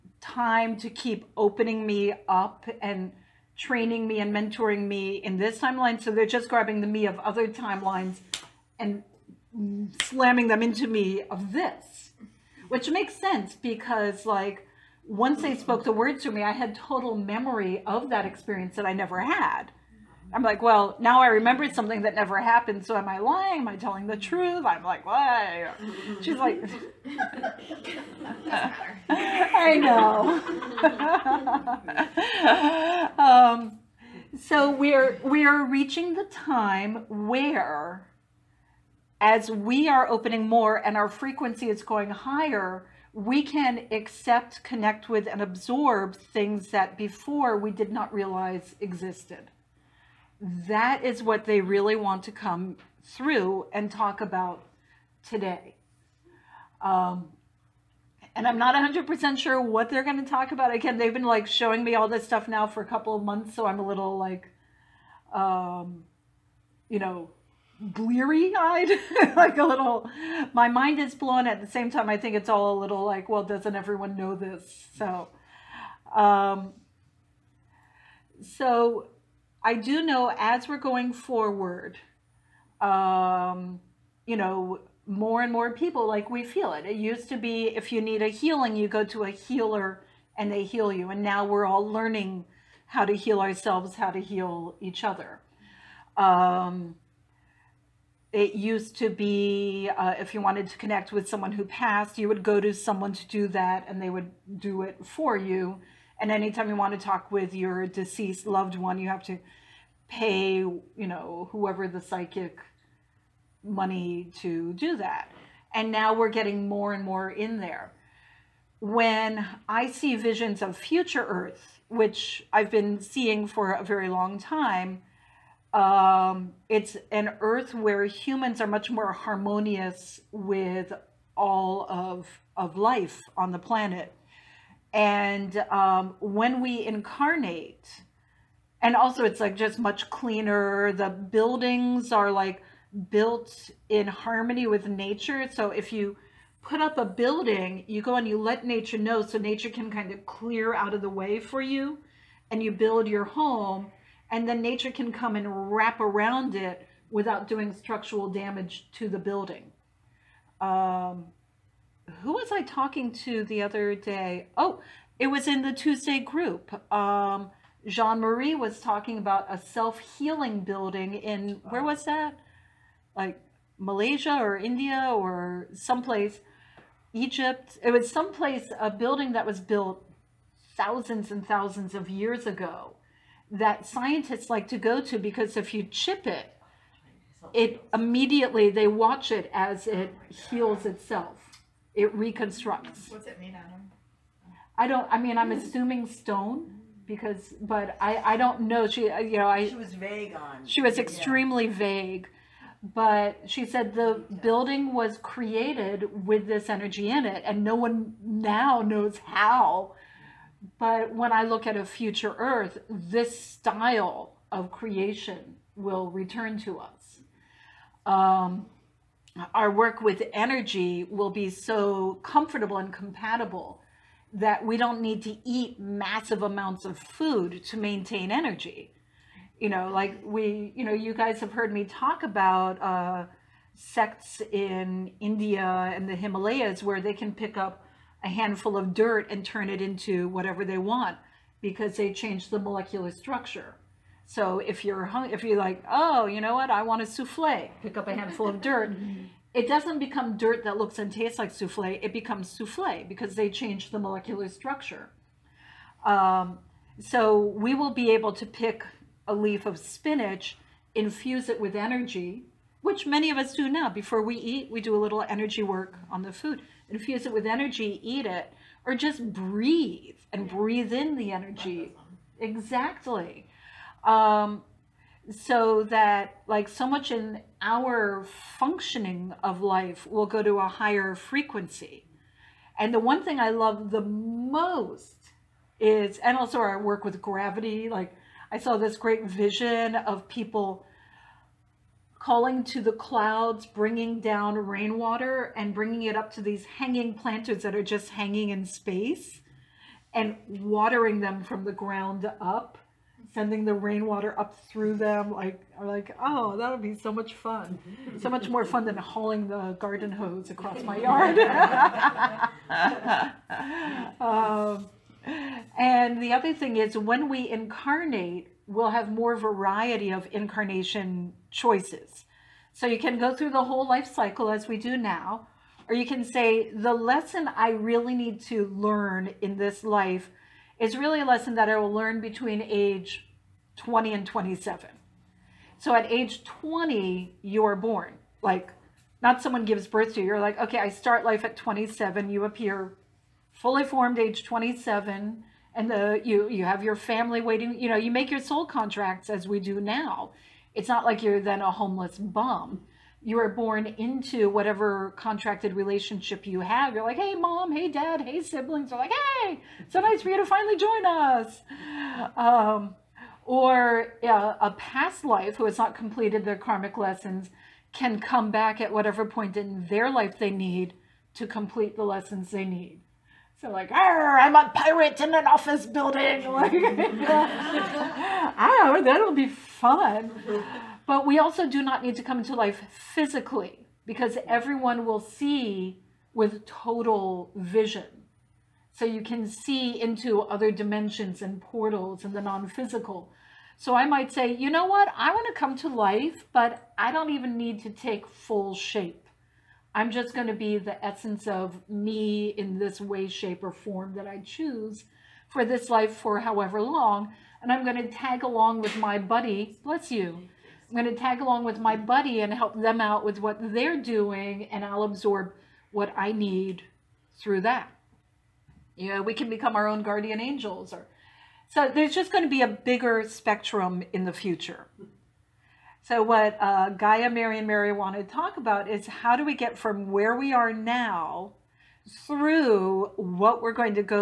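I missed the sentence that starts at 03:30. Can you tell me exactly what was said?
But when I look at a future Earth, this style of creation will return to us.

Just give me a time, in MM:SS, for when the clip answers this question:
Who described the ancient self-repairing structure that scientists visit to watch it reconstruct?
02:47.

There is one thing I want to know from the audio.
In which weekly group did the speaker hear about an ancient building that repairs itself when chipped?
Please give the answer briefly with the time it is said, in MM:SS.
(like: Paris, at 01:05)
Tuesday group, at 02:45.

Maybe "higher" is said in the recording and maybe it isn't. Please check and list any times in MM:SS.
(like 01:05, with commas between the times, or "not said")
00:42, 04:40.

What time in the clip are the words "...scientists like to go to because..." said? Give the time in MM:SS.
03:03.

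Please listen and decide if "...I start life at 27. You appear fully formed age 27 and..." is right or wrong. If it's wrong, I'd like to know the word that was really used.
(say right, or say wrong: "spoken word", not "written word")
right.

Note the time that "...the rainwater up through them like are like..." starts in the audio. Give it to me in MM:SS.
05:03.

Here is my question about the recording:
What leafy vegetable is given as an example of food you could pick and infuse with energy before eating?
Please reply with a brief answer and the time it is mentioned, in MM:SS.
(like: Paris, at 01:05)
Spinach, at 04:19.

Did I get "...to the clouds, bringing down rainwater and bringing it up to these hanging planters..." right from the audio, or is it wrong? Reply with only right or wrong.
right.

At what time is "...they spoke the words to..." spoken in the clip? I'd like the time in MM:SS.
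00:15.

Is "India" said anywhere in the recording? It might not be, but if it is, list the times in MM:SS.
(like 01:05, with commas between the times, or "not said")
02:54, 03:55.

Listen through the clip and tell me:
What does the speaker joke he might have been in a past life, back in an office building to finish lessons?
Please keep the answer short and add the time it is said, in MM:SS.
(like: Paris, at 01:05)
A pirate, at 06:14.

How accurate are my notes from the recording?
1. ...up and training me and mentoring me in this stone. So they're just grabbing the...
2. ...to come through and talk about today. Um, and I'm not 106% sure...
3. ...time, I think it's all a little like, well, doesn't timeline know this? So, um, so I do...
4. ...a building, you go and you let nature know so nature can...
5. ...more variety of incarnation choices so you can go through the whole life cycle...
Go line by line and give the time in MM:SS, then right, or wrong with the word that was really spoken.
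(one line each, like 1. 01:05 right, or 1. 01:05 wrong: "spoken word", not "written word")
1. 00:02 wrong: "timeline", not "stone"
2. 00:52 wrong: "100", not "106"
3. 01:11 wrong: "everyone", not "timeline"
4. 02:26 right
5. 05:19 right.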